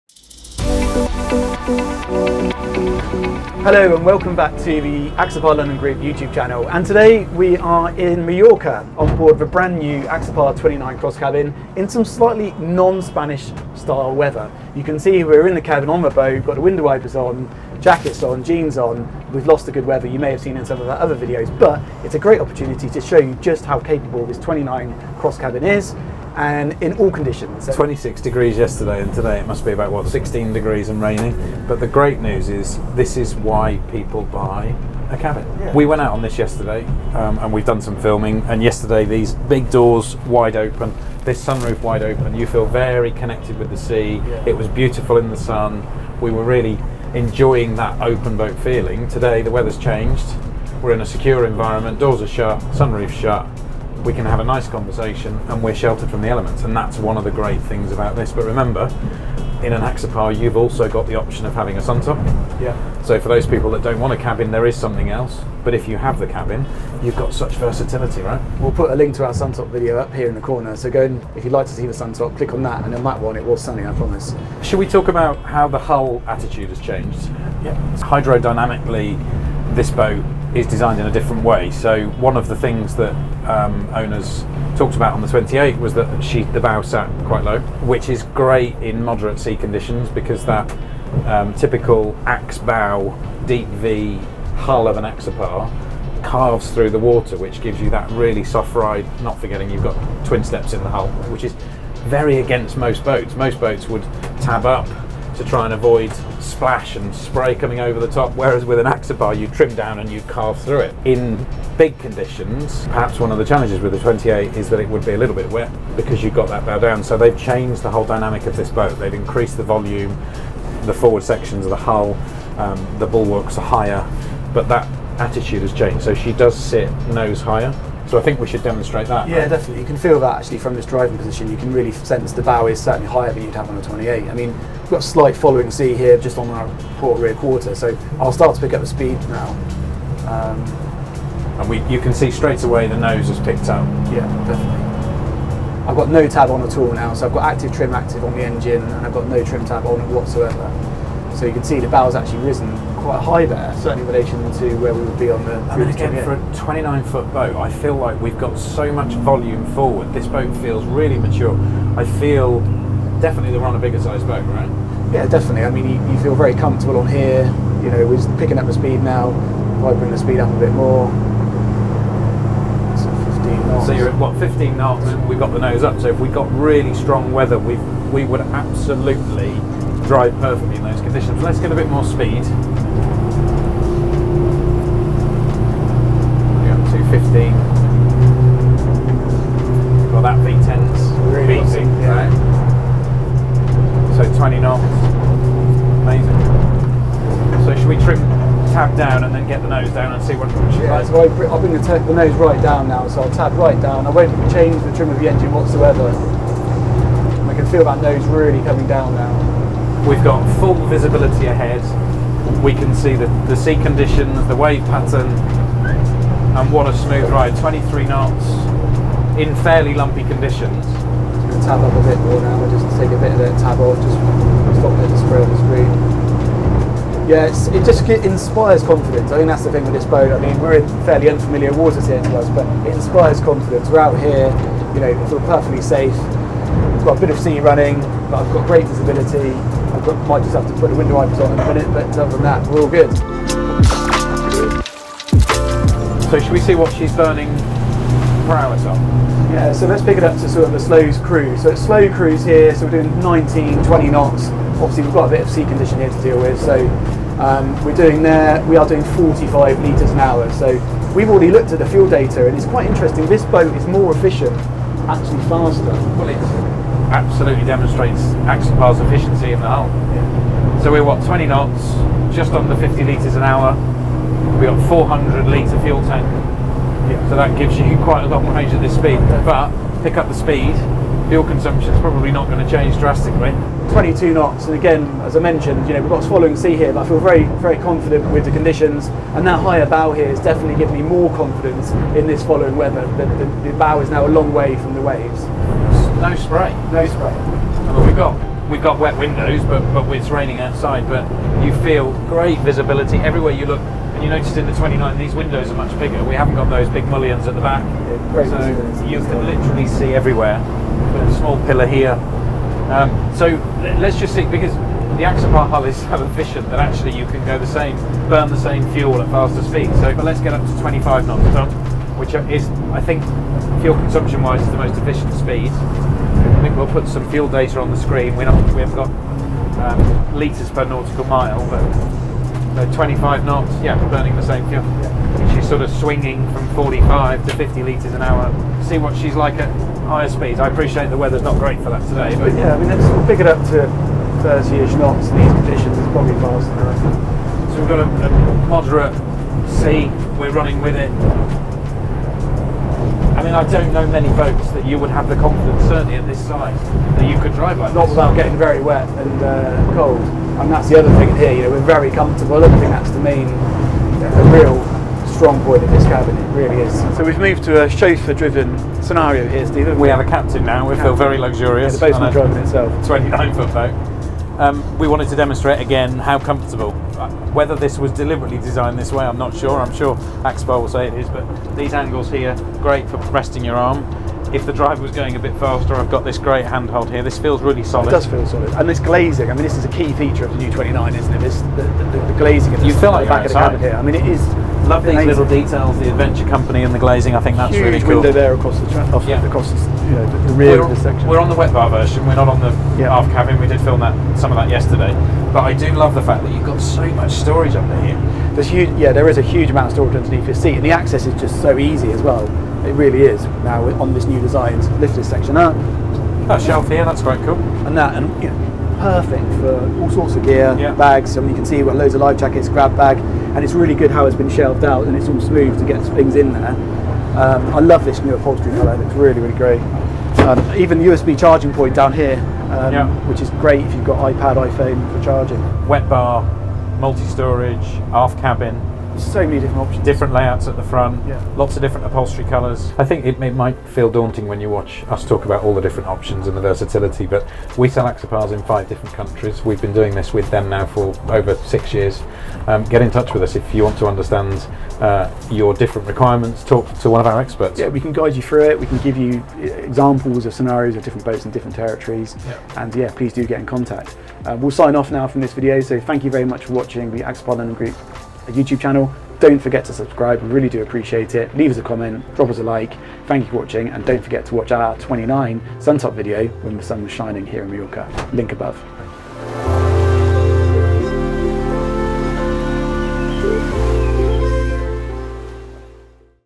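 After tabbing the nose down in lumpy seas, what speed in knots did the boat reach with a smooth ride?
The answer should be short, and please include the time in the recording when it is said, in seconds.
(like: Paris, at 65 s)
23 knots, at 217 s.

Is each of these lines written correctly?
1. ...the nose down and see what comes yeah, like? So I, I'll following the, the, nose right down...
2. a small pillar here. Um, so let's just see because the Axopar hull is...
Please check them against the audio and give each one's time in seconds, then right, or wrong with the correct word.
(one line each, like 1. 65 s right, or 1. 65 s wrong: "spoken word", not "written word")
1. 199 s wrong: "bring", not "following"
2. 310 s right.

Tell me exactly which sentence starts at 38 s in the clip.
And yesterday, these big doors wide open, this sunroof wide open.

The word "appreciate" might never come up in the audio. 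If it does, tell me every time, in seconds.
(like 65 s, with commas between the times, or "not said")
340 s, 470 s.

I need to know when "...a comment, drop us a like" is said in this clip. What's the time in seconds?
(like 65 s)
471 s.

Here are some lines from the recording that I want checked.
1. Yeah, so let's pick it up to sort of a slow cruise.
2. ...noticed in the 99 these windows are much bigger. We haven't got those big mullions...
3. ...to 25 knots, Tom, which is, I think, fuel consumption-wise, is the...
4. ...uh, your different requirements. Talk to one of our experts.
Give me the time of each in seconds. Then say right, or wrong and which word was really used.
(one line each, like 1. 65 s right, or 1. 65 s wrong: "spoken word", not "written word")
1. 249 s right
2. 304 s wrong: "29", not "99"
3. 320 s right
4. 455 s right.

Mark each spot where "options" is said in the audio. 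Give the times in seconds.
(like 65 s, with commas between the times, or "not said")
61 s, 439 s, 446 s.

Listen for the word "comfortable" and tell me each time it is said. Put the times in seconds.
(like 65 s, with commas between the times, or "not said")
166 s, 362 s, 376 s.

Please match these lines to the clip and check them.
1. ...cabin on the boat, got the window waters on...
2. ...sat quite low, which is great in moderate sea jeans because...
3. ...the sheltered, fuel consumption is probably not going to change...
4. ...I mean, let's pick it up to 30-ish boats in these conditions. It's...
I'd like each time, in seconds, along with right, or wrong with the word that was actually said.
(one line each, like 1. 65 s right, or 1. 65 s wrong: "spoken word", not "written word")
1. 15 s wrong: "wipers", not "waters"
2. 86 s wrong: "conditions", not "jeans"
3. 280 s wrong: "speed", not "sheltered"
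4. 342 s wrong: "knots", not "boats".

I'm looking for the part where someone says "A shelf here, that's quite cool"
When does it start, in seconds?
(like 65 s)
416 s.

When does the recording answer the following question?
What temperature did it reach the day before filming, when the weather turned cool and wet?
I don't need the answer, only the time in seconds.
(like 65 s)
27 s.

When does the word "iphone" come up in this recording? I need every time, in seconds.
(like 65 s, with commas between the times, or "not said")
434 s.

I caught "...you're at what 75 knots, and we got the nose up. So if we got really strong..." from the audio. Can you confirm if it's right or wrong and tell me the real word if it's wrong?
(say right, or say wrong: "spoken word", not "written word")
wrong: "15", not "75".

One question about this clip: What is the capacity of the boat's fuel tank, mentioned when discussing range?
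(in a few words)
400 litres.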